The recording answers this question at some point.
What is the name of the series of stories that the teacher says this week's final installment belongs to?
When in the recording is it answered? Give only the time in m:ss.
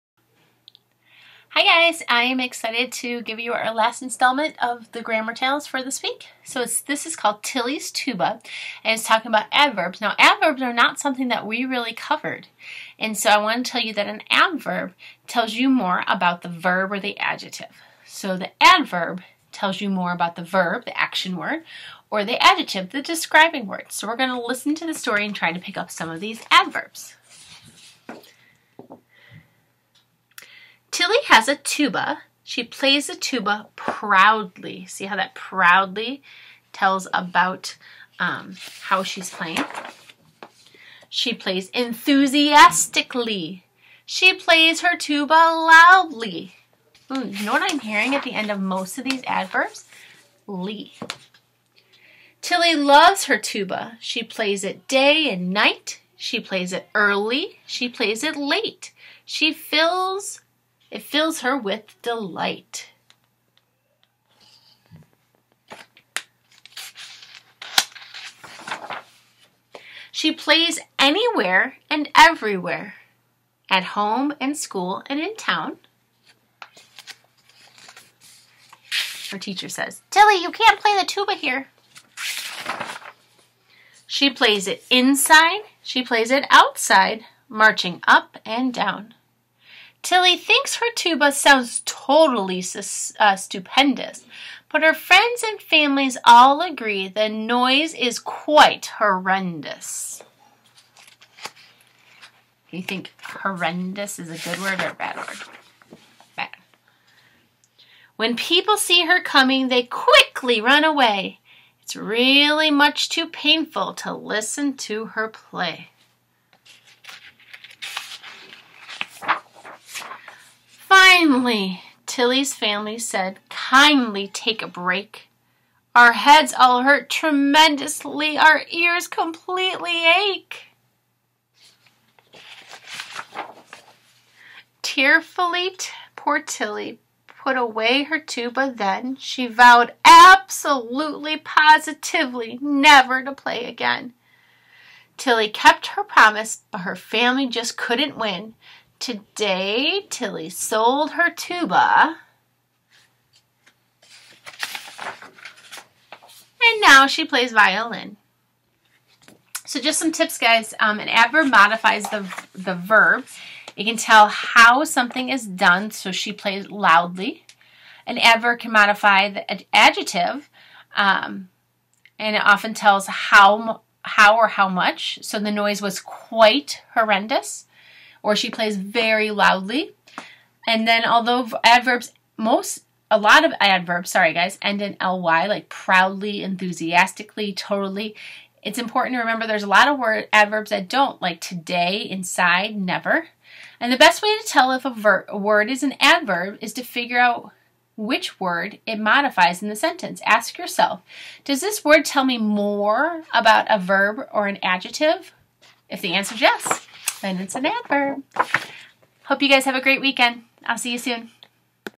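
0:05.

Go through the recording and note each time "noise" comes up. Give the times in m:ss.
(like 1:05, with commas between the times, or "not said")
1:37, 2:55.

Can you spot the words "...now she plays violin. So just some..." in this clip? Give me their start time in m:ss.
2:36.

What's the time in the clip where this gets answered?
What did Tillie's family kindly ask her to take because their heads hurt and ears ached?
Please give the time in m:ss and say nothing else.
2:04.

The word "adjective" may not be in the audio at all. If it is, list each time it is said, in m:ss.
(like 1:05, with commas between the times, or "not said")
0:17, 0:22, 2:49, 3:24.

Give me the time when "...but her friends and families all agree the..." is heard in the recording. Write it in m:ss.
1:34.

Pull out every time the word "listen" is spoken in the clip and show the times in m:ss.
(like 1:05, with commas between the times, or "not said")
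0:24, 1:54.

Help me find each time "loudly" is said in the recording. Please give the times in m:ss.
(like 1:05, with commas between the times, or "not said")
0:45, 2:46, 2:59.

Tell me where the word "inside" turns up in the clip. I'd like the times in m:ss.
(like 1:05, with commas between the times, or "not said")
1:24, 3:12.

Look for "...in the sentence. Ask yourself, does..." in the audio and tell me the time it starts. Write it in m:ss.
3:19.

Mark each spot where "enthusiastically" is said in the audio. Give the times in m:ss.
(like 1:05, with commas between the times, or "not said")
0:41, 3:06.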